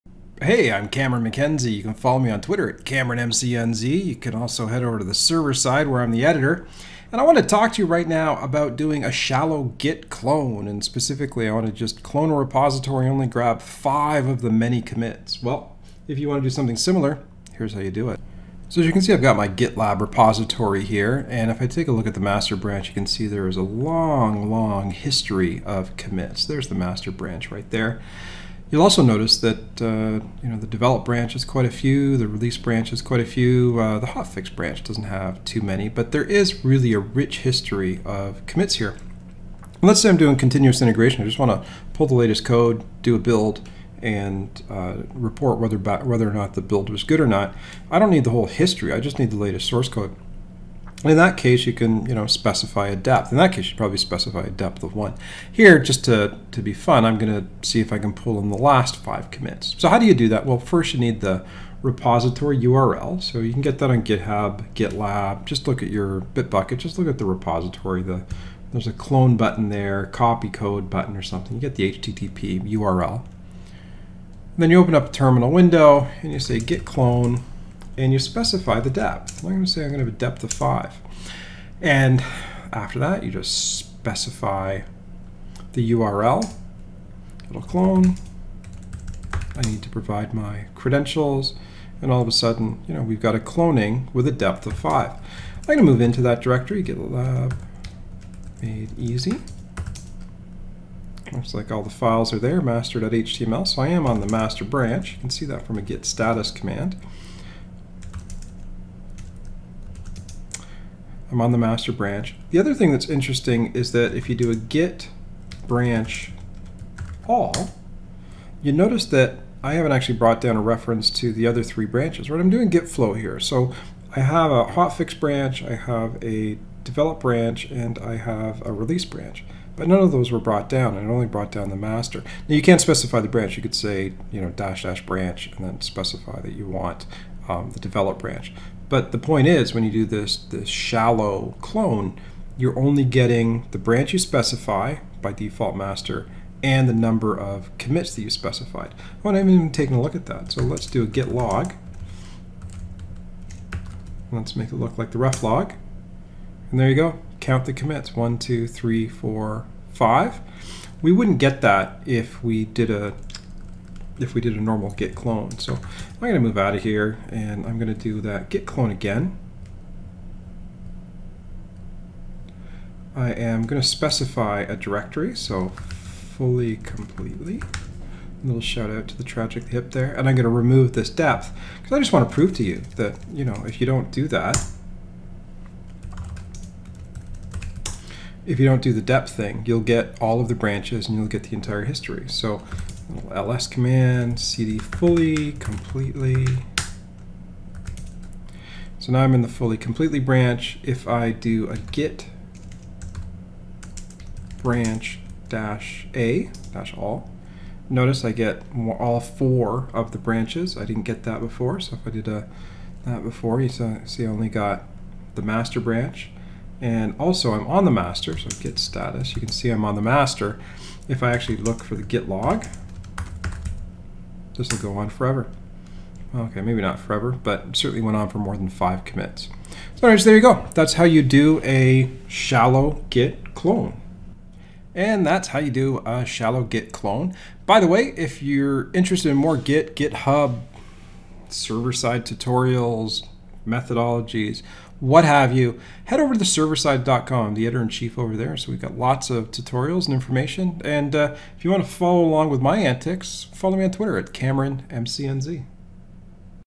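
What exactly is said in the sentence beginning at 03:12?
So ls command cd fully completely.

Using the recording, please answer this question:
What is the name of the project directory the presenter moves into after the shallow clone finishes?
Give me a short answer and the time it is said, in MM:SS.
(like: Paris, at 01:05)
GitLab made easy, at 01:36.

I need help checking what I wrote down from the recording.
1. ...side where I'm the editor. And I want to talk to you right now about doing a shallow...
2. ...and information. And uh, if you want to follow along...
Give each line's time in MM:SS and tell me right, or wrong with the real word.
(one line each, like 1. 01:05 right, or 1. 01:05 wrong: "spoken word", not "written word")
1. 00:05 right
2. 04:10 right.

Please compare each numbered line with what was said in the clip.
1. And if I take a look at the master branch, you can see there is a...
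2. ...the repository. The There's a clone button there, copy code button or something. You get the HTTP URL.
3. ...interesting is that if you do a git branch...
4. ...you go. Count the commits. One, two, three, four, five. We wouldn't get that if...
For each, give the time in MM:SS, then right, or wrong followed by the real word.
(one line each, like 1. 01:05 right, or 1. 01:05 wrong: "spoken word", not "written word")
1. 00:21 right
2. 01:07 right
3. 01:53 right
4. 02:36 right.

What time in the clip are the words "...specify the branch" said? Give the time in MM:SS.
02:12.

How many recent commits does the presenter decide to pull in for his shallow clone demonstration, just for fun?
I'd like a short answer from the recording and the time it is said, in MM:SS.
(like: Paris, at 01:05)
5, at 00:58.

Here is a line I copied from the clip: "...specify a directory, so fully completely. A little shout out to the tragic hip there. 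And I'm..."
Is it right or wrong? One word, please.
right.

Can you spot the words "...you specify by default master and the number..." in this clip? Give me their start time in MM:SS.
02:24.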